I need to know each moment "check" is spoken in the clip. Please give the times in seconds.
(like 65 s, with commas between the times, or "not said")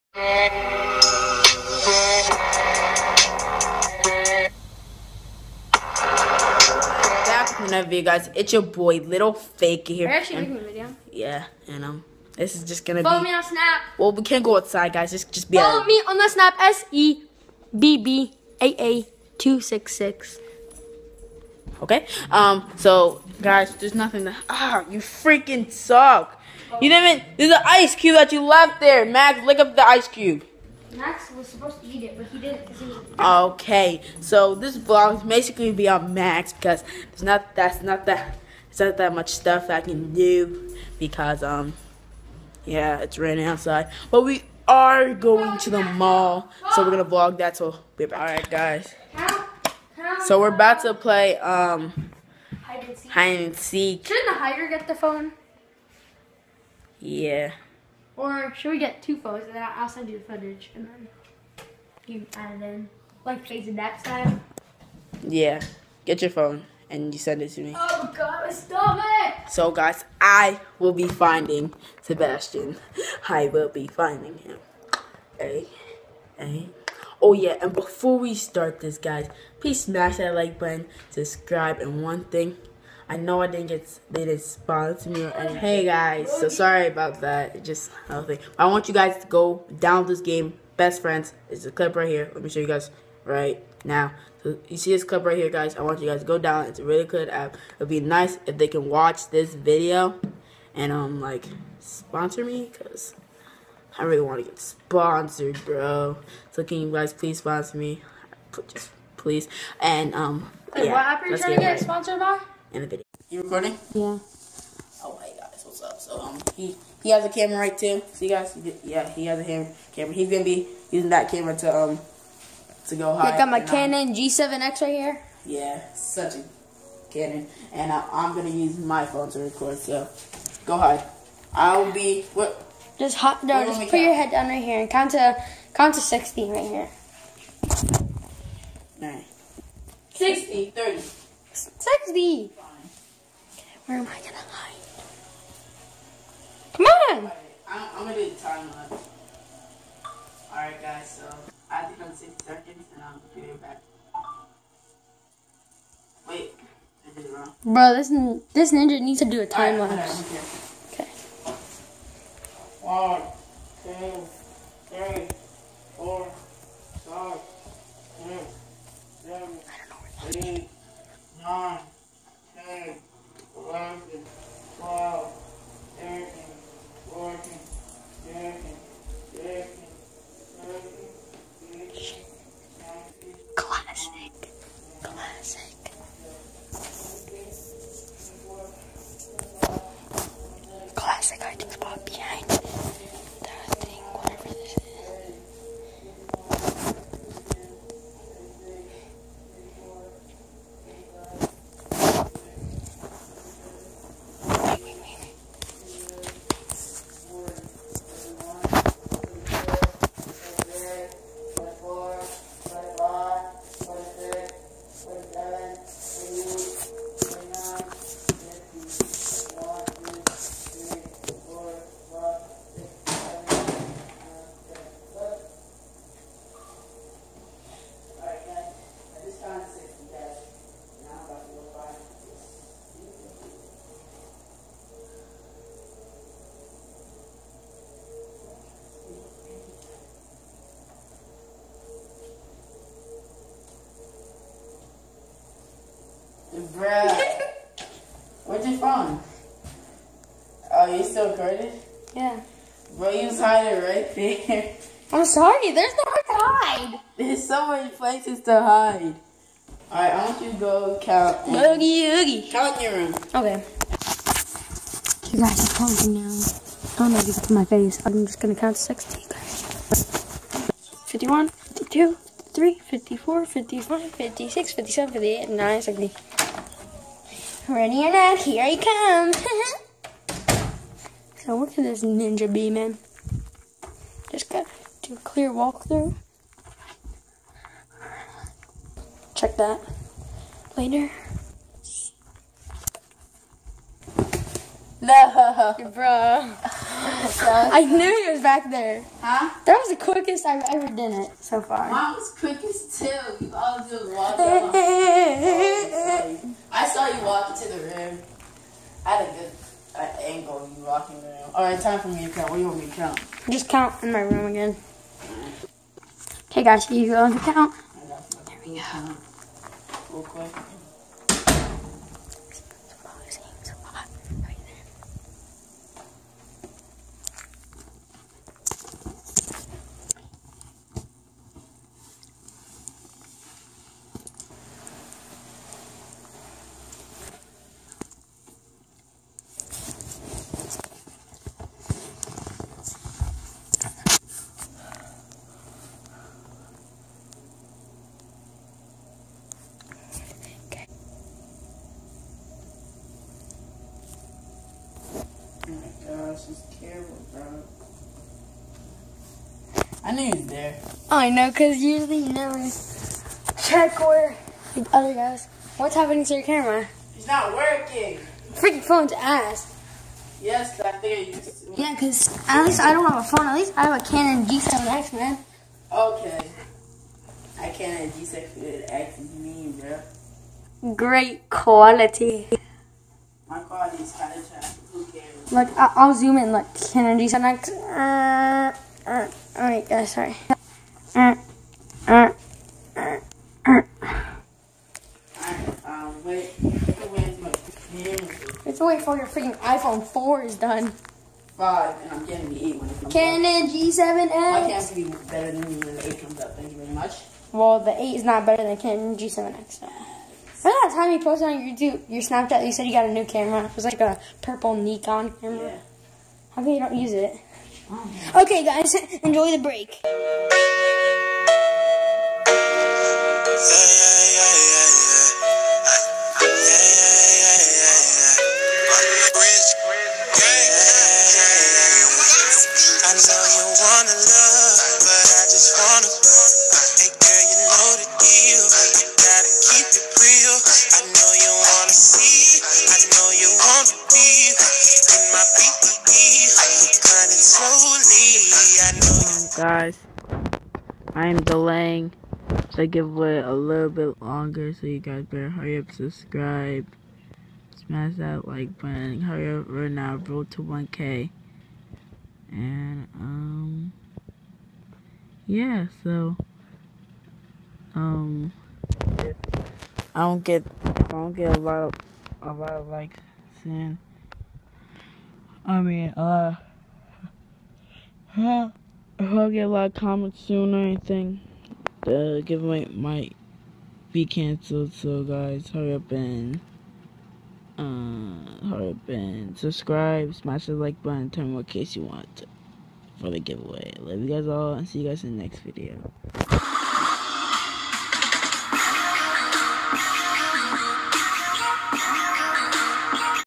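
289 s, 363 s.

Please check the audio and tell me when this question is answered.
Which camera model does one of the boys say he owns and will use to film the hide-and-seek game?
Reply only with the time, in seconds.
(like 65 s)
123 s.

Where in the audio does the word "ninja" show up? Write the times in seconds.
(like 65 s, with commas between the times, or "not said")
158 s, 282 s.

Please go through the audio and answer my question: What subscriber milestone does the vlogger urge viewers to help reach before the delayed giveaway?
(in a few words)
1K.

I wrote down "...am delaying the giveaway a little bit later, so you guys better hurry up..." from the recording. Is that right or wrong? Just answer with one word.
wrong.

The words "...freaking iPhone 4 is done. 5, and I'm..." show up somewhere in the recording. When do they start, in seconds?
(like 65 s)
399 s.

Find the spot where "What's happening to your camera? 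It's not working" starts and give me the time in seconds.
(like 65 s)
365 s.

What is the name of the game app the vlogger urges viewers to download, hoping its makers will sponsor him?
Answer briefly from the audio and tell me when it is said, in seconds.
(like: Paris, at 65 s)
Best Friends, at 90 s.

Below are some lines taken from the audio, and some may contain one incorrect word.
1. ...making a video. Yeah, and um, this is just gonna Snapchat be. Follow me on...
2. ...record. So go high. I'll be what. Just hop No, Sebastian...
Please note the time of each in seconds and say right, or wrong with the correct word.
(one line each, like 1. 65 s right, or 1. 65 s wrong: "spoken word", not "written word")
1. 10 s wrong: "Follow", not "Snapchat"
2. 129 s wrong: "Just", not "Sebastian".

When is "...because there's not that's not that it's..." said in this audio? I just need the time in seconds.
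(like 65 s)
36 s.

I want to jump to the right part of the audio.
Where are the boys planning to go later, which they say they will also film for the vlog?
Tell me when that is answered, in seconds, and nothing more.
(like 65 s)
45 s.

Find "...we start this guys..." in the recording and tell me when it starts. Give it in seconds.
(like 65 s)
78 s.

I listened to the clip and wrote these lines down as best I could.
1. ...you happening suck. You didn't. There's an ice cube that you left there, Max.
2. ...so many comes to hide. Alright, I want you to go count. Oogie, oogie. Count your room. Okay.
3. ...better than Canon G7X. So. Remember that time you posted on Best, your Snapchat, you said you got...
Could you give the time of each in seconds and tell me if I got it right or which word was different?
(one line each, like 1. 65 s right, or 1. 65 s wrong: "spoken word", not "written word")
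1. 24 s wrong: "freaking", not "happening"
2. 257 s wrong: "places", not "comes"
3. 408 s wrong: "YouTube", not "Best".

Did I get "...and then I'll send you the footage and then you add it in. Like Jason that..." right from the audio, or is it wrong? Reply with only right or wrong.
right.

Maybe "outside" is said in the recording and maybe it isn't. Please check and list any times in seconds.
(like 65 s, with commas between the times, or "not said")
14 s, 43 s.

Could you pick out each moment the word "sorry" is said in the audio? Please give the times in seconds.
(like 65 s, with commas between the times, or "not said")
86 s, 255 s, 390 s.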